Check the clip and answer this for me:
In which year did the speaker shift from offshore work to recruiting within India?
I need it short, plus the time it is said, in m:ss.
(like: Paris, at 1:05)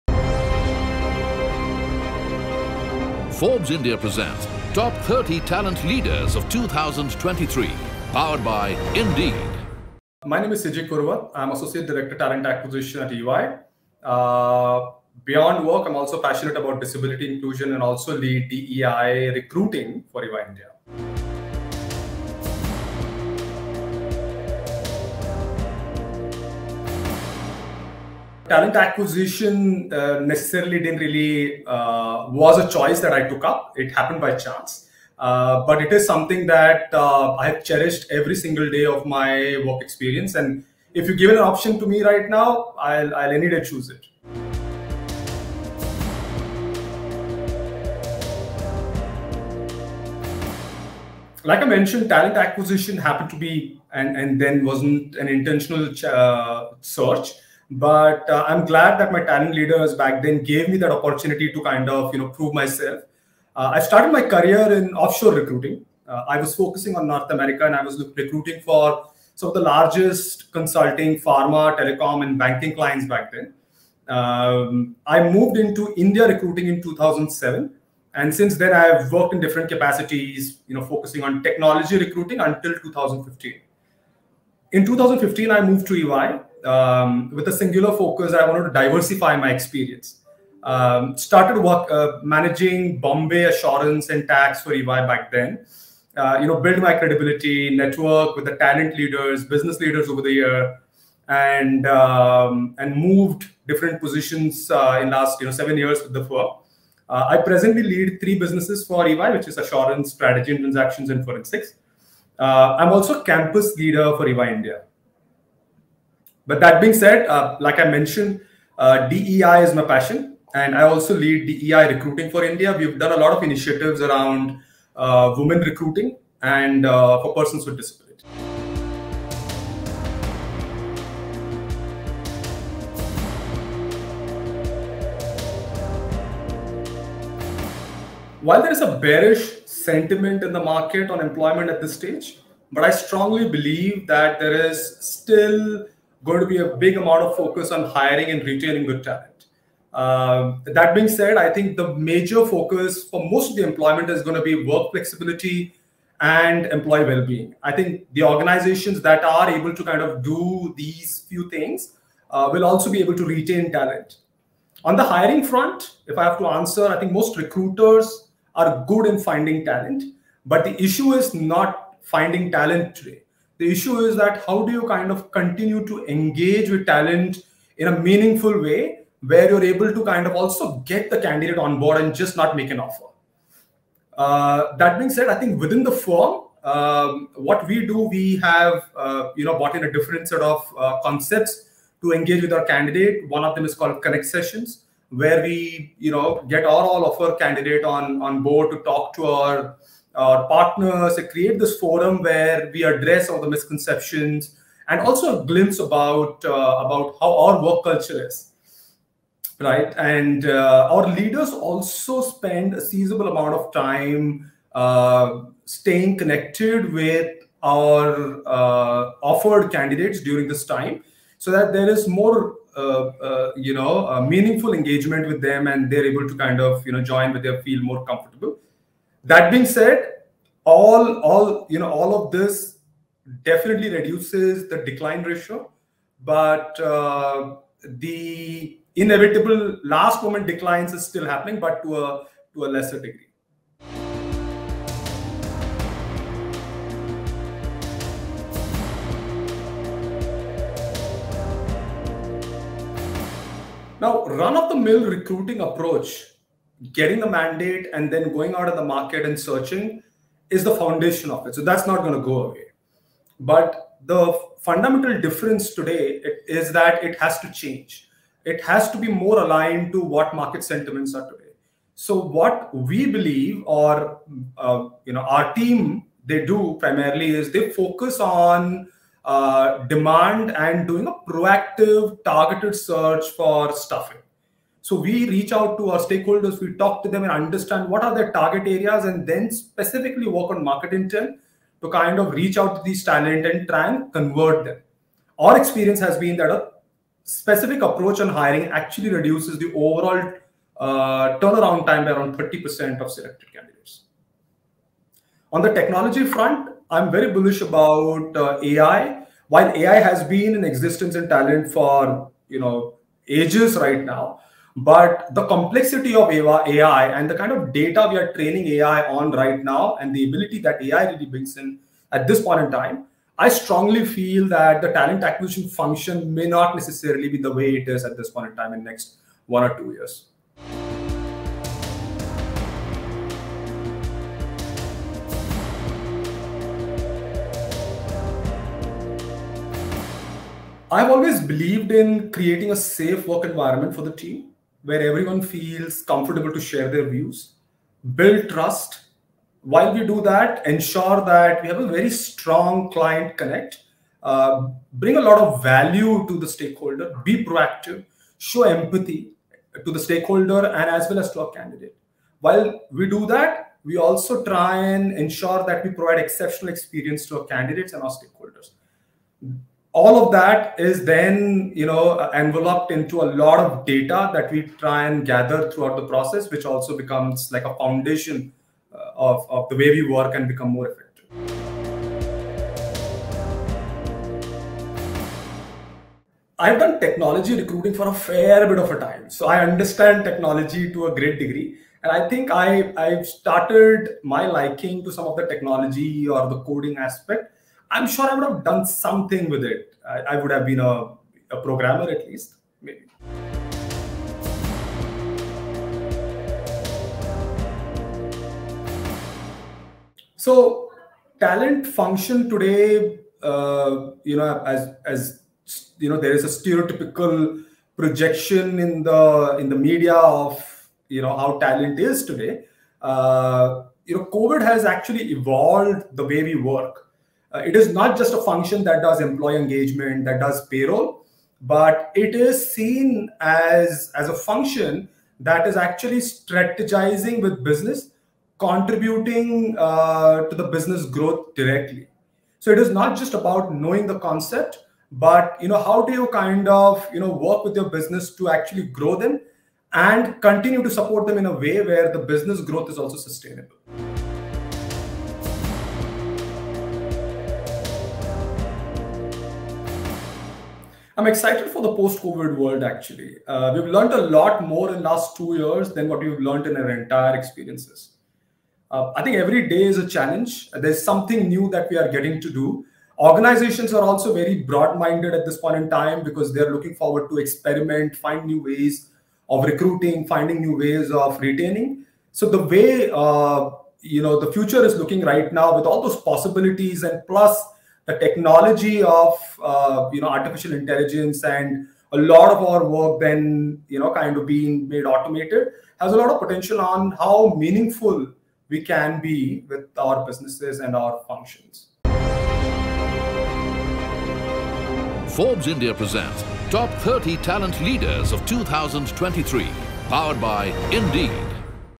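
2007, at 1:16.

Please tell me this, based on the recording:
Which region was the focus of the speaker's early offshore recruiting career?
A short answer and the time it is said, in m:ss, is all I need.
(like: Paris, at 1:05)
North America, at 1:07.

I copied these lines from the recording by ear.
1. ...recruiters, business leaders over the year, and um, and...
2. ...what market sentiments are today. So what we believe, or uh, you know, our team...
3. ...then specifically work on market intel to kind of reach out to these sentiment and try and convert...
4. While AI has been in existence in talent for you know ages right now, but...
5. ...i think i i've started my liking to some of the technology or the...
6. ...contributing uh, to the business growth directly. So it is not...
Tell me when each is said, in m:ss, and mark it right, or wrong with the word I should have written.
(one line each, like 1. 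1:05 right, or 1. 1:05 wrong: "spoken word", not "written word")
1. 1:38 wrong: "leaders", not "recruiters"
2. 4:30 right
3. 4:49 wrong: "talent", not "sentiment"
4. 5:09 right
5. 6:32 right
6. 7:18 right.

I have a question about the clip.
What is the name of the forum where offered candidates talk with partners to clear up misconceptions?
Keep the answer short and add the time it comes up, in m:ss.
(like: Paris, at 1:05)
Connect Sessions, at 3:14.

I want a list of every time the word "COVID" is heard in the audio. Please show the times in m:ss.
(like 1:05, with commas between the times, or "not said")
7:04, 7:41.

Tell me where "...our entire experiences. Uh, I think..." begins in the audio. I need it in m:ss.
7:46.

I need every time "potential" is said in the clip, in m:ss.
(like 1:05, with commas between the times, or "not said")
8:16.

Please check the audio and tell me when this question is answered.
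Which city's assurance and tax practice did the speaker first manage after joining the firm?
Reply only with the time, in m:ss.
1:32.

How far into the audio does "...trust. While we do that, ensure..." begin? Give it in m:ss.
5:48.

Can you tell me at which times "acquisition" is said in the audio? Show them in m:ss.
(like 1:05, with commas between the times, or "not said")
0:12, 0:28, 0:52, 5:25.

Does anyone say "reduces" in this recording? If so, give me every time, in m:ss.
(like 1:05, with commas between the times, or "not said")
3:53, 4:59.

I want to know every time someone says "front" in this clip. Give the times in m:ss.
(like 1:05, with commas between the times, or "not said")
2:45, 5:06.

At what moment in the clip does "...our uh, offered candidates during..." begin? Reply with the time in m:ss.
3:37.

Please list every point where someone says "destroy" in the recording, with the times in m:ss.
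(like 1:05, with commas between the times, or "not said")
not said.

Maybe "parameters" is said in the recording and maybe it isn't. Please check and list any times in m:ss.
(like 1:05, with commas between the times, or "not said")
not said.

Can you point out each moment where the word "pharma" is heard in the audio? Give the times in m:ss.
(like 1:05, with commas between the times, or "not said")
1:11.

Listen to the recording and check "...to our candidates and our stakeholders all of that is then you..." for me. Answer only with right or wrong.
right.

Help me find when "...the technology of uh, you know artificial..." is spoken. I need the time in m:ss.
8:08.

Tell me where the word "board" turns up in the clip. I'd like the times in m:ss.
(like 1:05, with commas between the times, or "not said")
3:01, 3:18.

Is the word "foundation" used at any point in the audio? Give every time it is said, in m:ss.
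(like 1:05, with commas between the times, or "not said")
4:20, 6:17.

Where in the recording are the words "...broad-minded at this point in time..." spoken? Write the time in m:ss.
7:54.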